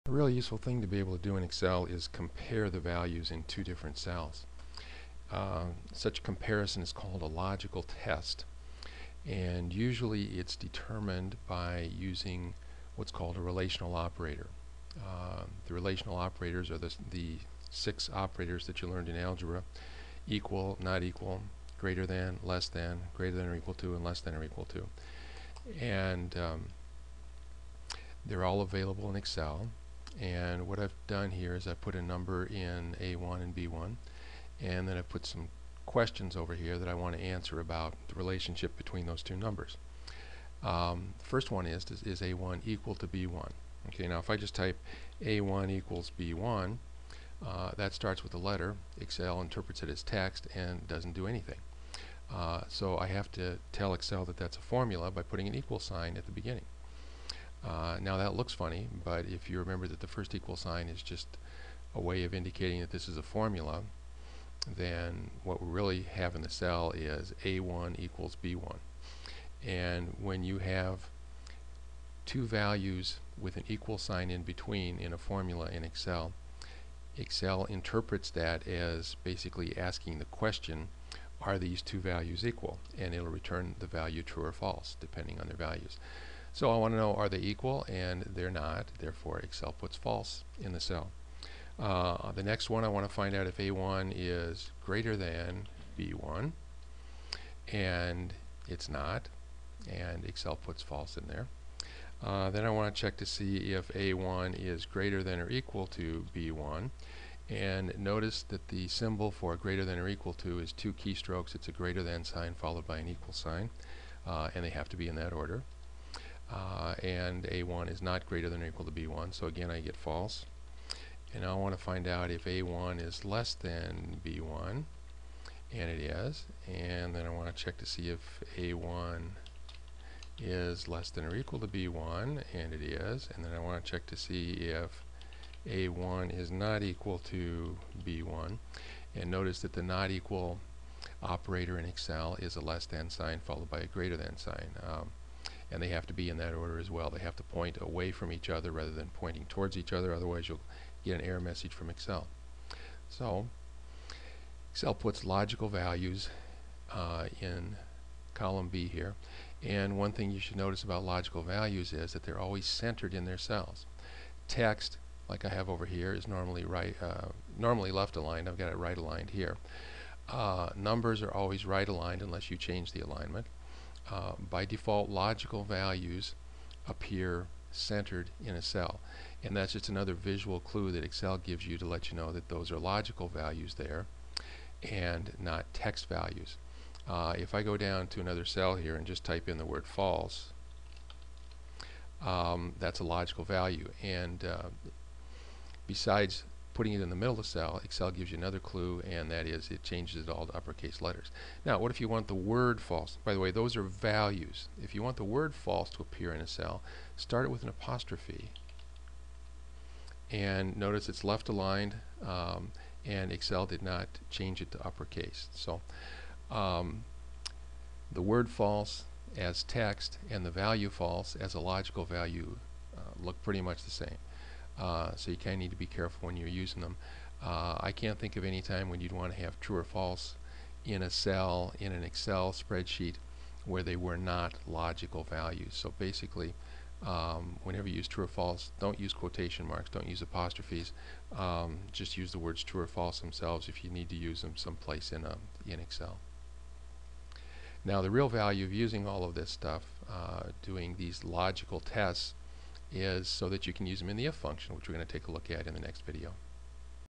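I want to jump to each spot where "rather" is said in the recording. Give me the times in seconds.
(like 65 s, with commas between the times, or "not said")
148 s.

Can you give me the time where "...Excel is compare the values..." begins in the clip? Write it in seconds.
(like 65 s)
1 s.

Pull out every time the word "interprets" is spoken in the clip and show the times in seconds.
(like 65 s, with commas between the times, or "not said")
49 s, 77 s.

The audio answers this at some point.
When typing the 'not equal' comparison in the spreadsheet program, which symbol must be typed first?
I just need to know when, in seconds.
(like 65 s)
142 s.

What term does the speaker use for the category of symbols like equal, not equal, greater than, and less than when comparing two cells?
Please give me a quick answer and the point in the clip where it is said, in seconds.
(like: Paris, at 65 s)
relational operator, at 13 s.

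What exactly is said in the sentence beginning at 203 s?
By the way, those are values.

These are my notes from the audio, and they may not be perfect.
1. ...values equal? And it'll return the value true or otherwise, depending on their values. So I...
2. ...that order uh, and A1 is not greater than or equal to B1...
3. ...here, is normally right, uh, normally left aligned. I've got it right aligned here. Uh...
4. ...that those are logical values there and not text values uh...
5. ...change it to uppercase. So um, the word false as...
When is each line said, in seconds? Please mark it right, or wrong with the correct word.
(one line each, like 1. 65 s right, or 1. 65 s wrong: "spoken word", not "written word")
1. 81 s wrong: "false", not "otherwise"
2. 115 s right
3. 165 s right
4. 182 s right
5. 214 s right.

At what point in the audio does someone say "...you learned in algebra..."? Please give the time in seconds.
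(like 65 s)
18 s.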